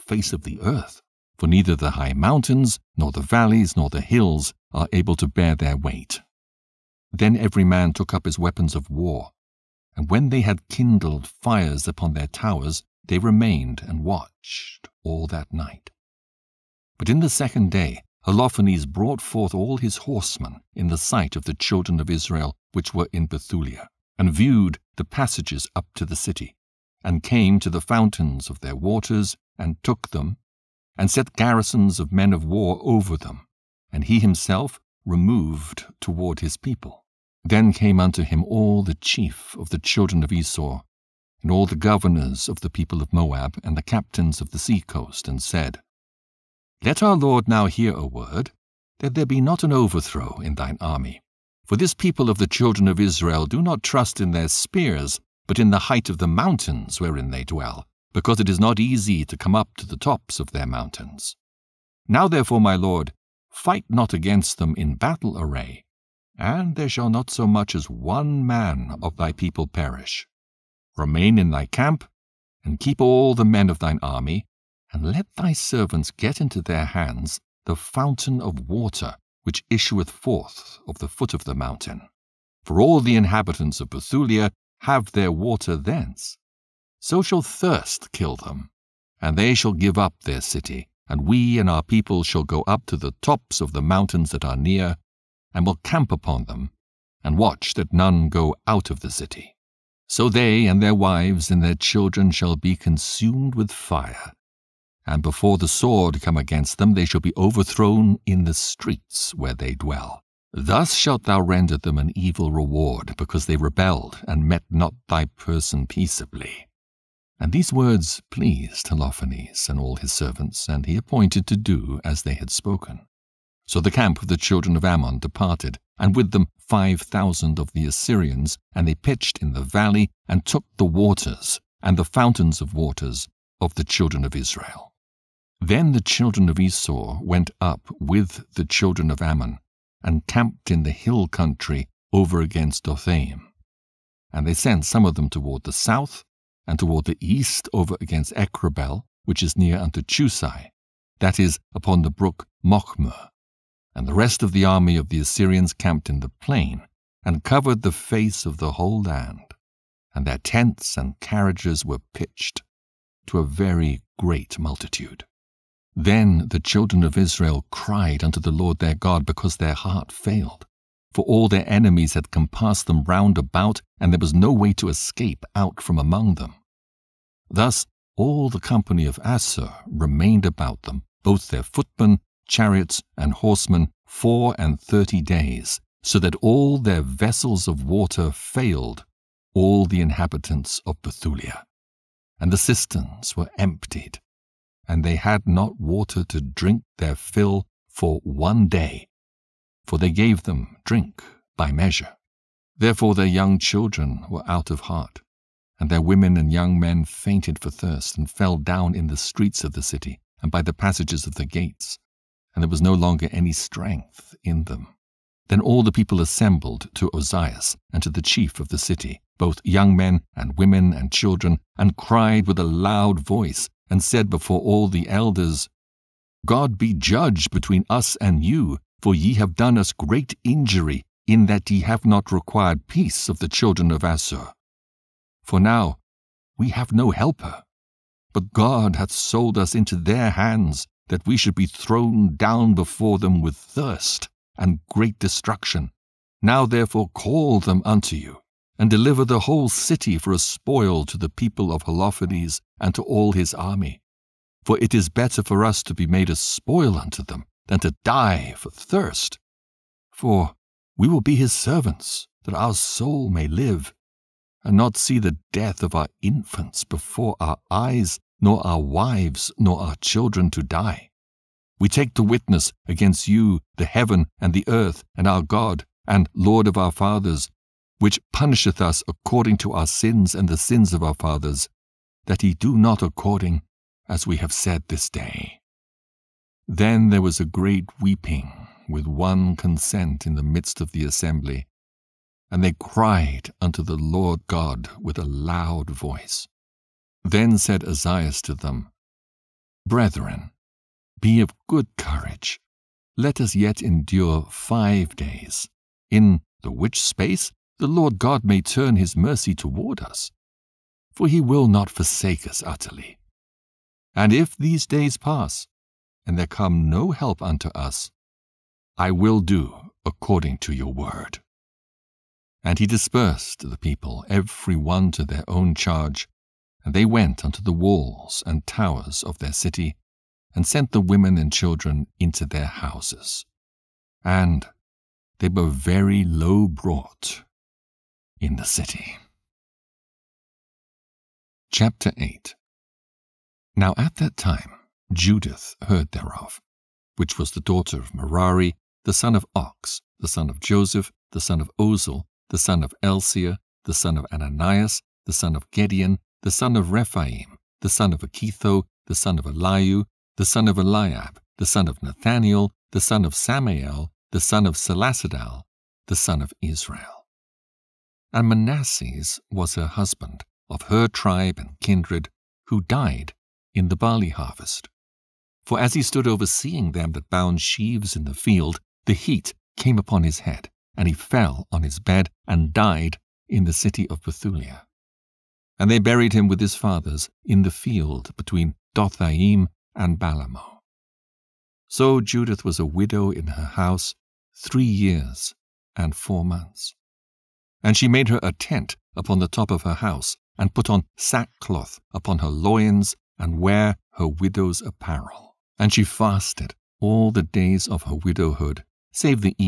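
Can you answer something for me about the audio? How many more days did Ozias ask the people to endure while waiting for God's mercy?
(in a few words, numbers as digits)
5.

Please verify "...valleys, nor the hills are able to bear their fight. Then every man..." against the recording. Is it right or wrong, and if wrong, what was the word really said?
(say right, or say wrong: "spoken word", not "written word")
wrong: "weight", not "fight".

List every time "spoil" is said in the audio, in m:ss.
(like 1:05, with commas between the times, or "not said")
4:10, 4:16.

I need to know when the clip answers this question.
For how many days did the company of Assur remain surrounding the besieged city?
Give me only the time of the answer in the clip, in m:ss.
3:04.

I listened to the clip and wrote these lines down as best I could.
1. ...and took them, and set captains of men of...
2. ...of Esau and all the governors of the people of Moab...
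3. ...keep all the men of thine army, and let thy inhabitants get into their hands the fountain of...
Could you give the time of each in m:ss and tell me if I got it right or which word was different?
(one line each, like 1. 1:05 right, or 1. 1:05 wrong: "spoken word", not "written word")
1. 0:29 wrong: "garrisons", not "captains"
2. 0:40 right
3. 1:12 wrong: "servants", not "inhabitants".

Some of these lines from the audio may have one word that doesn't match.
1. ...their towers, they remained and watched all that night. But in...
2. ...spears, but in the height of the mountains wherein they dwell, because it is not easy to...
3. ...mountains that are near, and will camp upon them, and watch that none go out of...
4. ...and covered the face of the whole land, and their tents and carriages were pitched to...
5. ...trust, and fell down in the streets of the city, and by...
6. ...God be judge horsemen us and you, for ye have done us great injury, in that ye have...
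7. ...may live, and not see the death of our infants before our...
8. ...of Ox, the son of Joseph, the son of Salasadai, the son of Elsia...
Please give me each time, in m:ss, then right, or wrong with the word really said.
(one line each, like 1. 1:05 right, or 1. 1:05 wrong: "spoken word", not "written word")
1. 0:12 right
2. 0:54 right
3. 1:33 right
4. 2:37 right
5. 3:27 wrong: "thirst", not "trust"
6. 3:46 wrong: "between", not "horsemen"
7. 4:23 right
8. 5:49 wrong: "Oziel", not "Salasadai".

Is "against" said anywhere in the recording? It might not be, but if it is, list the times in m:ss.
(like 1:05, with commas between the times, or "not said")
1:04, 1:46, 2:22, 2:28, 4:32.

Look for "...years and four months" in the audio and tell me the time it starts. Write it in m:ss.
6:34.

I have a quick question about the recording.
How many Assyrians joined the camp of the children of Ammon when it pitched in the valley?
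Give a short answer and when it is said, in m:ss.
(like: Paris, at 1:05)
5000, at 2:06.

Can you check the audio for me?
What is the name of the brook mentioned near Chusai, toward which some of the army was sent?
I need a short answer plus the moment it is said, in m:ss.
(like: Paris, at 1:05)
Mochmer, at 2:32.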